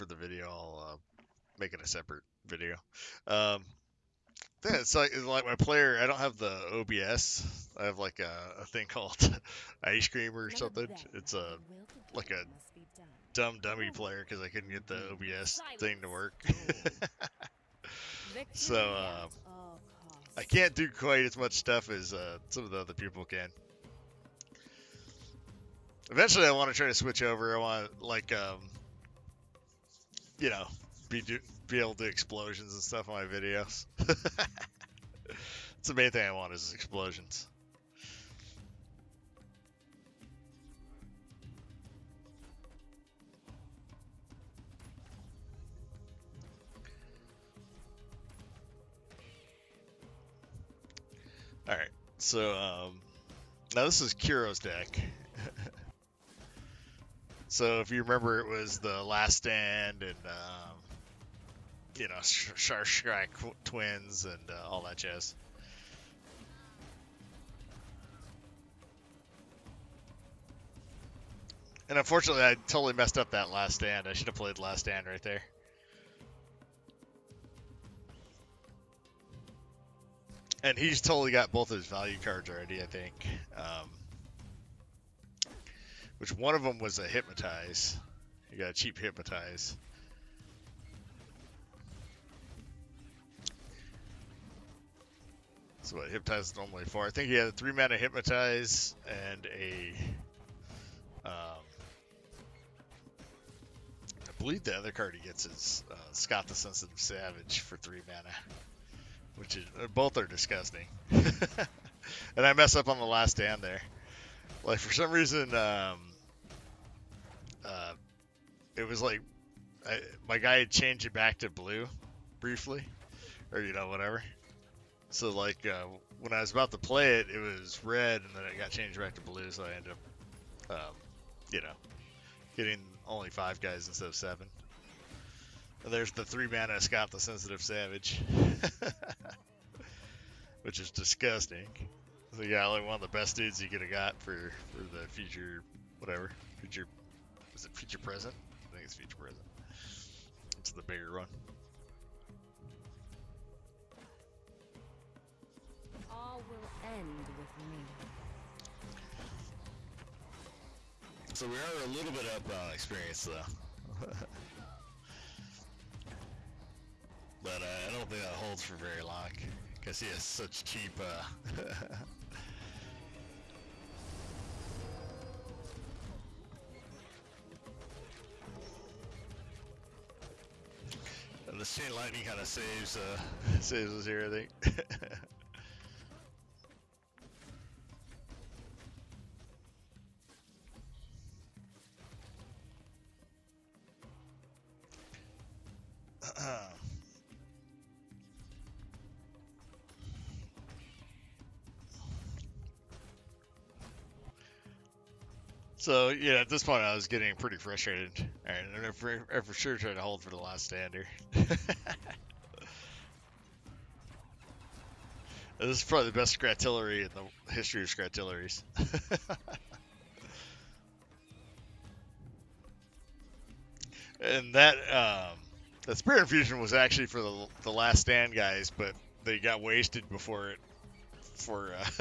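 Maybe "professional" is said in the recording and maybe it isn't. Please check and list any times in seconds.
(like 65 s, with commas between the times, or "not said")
not said.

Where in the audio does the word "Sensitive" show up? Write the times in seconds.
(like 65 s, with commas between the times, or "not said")
106 s, 137 s.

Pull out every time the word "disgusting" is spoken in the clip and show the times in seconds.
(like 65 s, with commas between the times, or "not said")
110 s, 140 s.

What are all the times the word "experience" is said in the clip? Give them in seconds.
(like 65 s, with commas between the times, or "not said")
162 s.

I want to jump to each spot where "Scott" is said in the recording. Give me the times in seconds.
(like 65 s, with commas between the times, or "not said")
106 s, 136 s.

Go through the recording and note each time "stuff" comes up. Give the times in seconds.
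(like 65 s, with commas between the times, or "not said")
21 s, 32 s.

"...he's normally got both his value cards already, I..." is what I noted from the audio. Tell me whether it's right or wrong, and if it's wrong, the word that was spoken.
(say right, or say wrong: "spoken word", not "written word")
wrong: "totally", not "normally".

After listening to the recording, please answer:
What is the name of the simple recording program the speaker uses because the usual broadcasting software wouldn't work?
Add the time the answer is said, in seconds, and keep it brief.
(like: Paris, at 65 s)
Ice Cream, at 9 s.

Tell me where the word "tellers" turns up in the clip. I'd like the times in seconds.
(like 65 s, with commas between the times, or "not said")
not said.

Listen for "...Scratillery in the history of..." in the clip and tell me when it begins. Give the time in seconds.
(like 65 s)
216 s.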